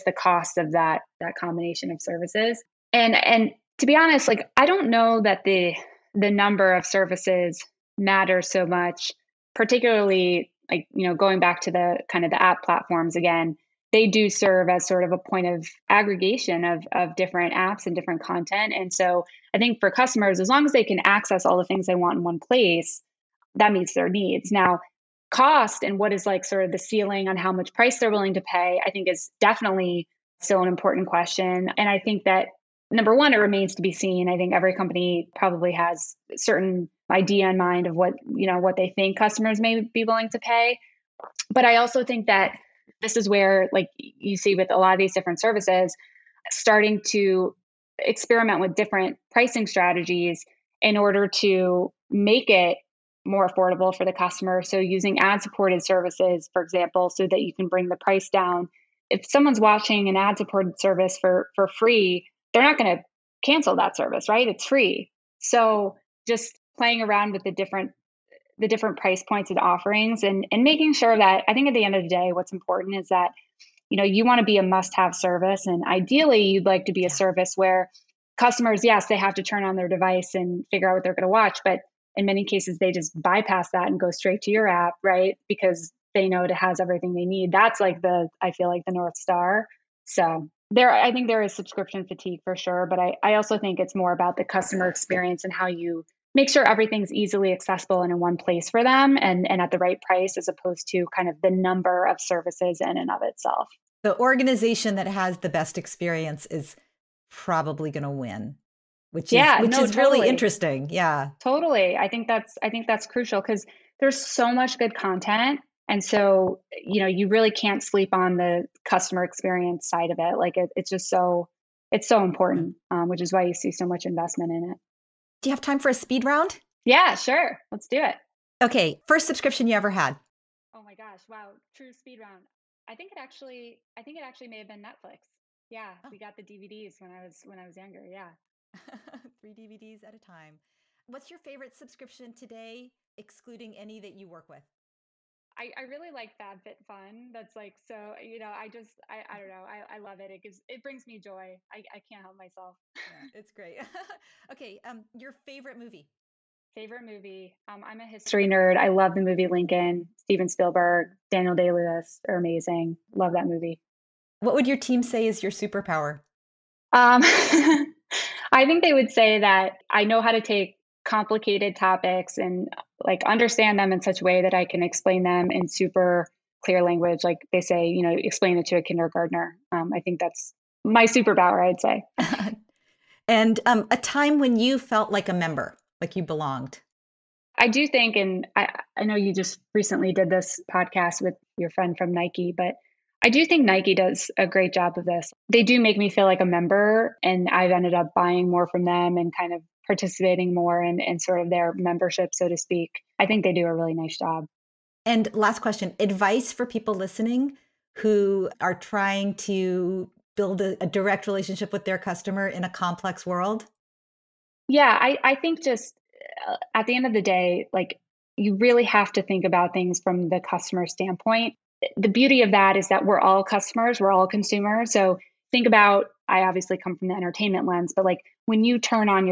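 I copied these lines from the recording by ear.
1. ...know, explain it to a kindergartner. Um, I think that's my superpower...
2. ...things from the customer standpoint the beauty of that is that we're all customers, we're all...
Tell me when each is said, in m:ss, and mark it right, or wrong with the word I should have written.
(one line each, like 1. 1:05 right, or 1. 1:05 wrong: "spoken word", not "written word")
1. 2:58 right
2. 3:39 right.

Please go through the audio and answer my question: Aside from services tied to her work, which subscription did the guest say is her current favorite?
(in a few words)
FabFitFun.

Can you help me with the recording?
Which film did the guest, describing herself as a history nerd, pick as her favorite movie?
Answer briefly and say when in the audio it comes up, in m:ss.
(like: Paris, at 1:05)
Lincoln, at 2:39.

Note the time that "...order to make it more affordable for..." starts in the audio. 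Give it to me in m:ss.
0:50.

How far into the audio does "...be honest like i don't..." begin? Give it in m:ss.
0:03.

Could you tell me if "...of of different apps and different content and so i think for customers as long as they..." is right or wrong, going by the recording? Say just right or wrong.
right.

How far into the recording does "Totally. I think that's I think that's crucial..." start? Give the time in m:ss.
1:51.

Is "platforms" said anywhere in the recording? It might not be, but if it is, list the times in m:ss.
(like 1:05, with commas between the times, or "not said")
0:12.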